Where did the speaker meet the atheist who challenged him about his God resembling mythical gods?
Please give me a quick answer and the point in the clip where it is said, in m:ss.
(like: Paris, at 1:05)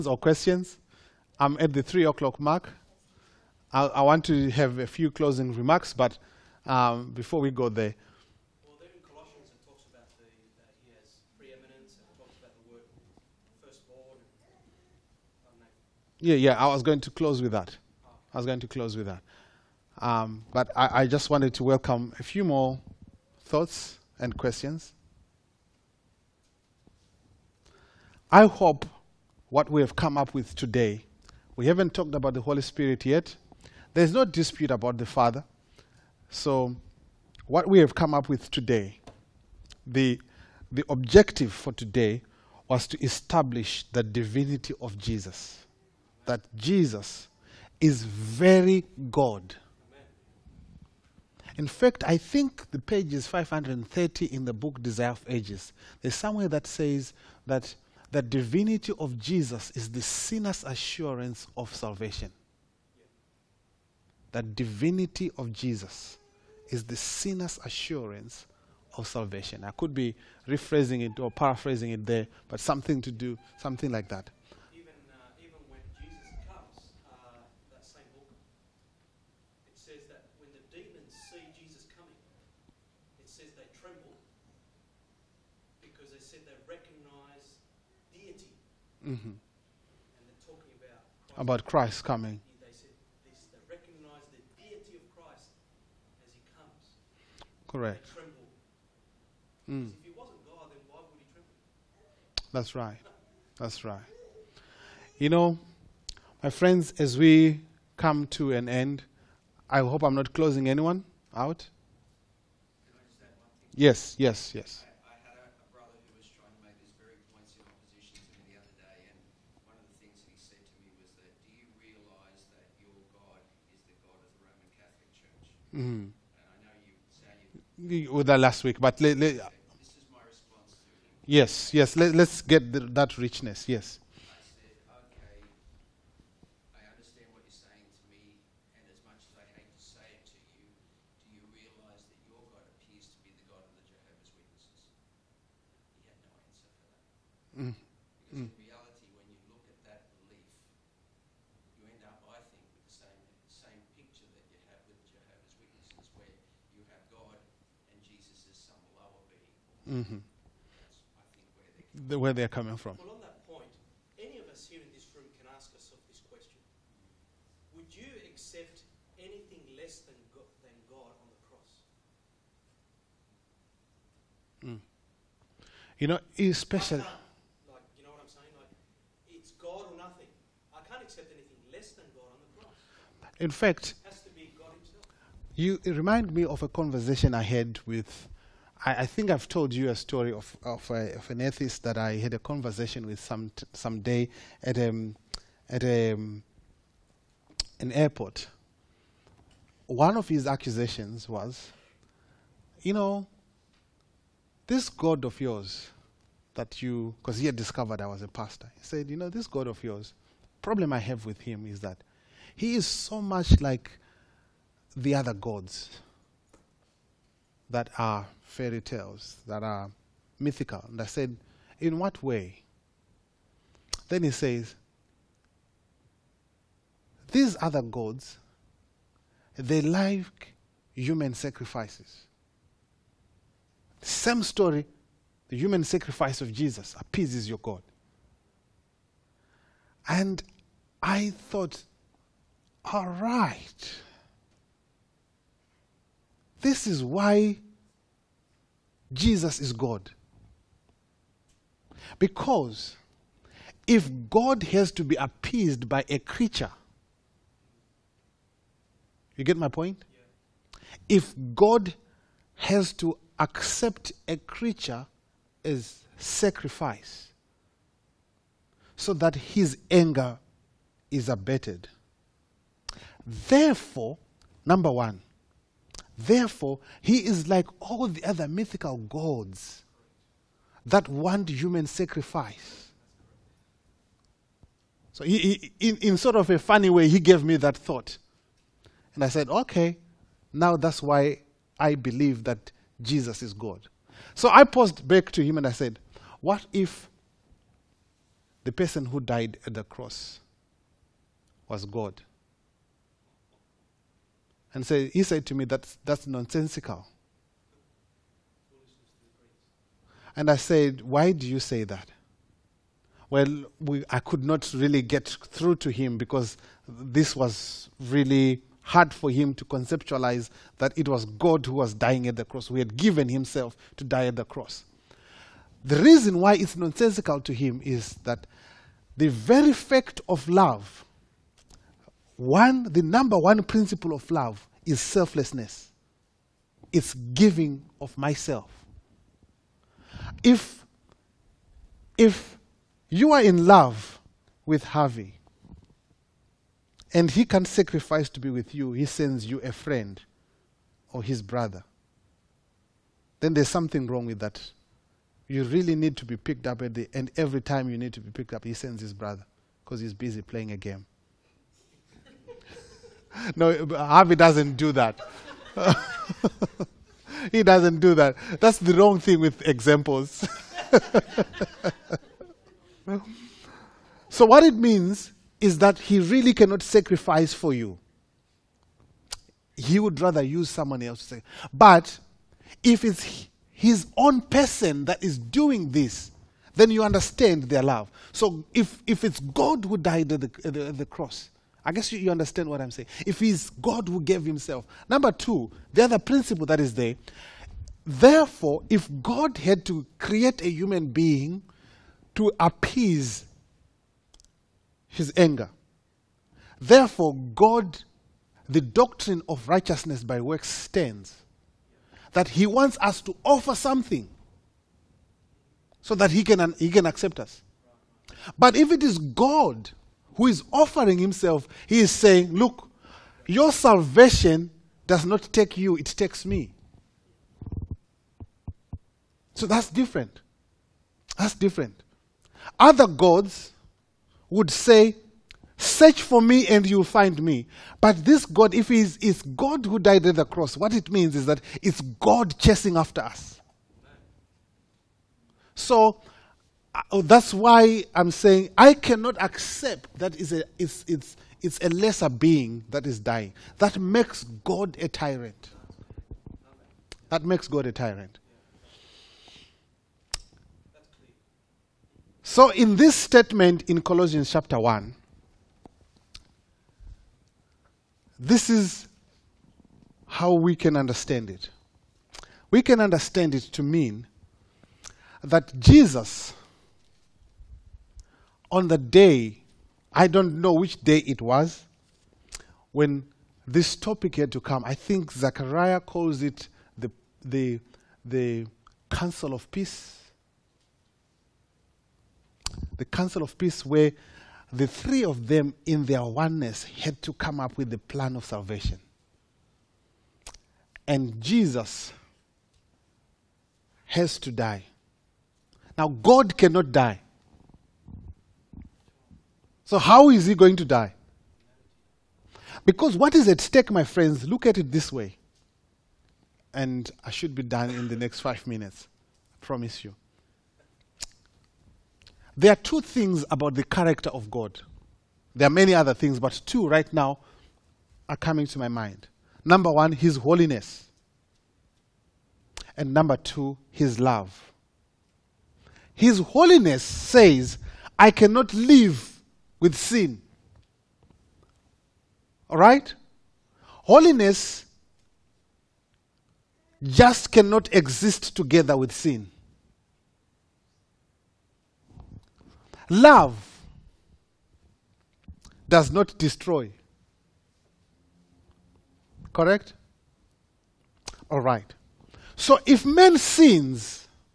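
An airport, at 3:17.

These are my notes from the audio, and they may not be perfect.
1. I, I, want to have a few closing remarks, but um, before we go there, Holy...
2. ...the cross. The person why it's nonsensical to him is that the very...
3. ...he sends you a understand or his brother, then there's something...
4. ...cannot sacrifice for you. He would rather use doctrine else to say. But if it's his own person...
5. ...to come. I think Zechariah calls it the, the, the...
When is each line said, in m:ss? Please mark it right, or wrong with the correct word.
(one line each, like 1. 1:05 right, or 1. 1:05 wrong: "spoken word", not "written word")
1. 0:03 wrong: "Yeah", not "Holy"
2. 5:24 wrong: "reason", not "person"
3. 5:48 wrong: "friend", not "understand"
4. 6:16 wrong: "someone", not "doctrine"
5. 8:04 right.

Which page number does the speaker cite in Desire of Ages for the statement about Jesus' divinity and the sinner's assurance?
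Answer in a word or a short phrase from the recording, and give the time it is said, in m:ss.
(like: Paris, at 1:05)
530, at 0:53.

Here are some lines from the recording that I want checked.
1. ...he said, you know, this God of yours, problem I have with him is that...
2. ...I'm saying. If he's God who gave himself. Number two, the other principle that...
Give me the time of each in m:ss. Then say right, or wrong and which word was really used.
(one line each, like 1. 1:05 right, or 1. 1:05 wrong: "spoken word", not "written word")
1. 3:28 right
2. 6:32 right.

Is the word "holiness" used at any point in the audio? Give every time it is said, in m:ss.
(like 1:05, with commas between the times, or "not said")
8:50, 8:56, 9:04.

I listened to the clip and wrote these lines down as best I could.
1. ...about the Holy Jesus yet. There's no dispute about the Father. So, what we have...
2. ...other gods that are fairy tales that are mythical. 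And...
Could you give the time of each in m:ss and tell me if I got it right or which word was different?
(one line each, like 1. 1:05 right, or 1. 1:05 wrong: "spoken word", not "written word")
1. 0:32 wrong: "Spirit", not "Jesus"
2. 3:35 right.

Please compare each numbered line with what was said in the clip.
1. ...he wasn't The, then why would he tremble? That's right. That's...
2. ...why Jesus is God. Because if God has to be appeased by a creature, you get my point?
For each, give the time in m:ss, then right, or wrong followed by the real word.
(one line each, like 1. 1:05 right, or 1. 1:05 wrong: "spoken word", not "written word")
1. 1:40 wrong: "God", not "The"
2. 4:07 right.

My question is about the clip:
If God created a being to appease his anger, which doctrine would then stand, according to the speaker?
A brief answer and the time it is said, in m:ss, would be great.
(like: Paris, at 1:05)
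Righteousness by works, at 6:49.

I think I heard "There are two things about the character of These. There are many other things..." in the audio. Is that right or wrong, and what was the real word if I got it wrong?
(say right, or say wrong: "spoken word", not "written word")
wrong: "God", not "These".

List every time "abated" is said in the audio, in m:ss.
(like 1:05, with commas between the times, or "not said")
4:31.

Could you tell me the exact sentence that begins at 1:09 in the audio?
I could be rephrasing it or paraphrasing it there, but something to do, something like that.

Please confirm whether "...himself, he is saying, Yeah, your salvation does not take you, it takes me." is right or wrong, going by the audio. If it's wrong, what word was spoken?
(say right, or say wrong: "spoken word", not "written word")
wrong: "Look", not "Yeah".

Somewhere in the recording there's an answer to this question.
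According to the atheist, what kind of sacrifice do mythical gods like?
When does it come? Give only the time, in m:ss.
3:50.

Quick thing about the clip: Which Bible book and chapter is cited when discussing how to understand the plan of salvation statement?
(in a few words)
Colossians 1.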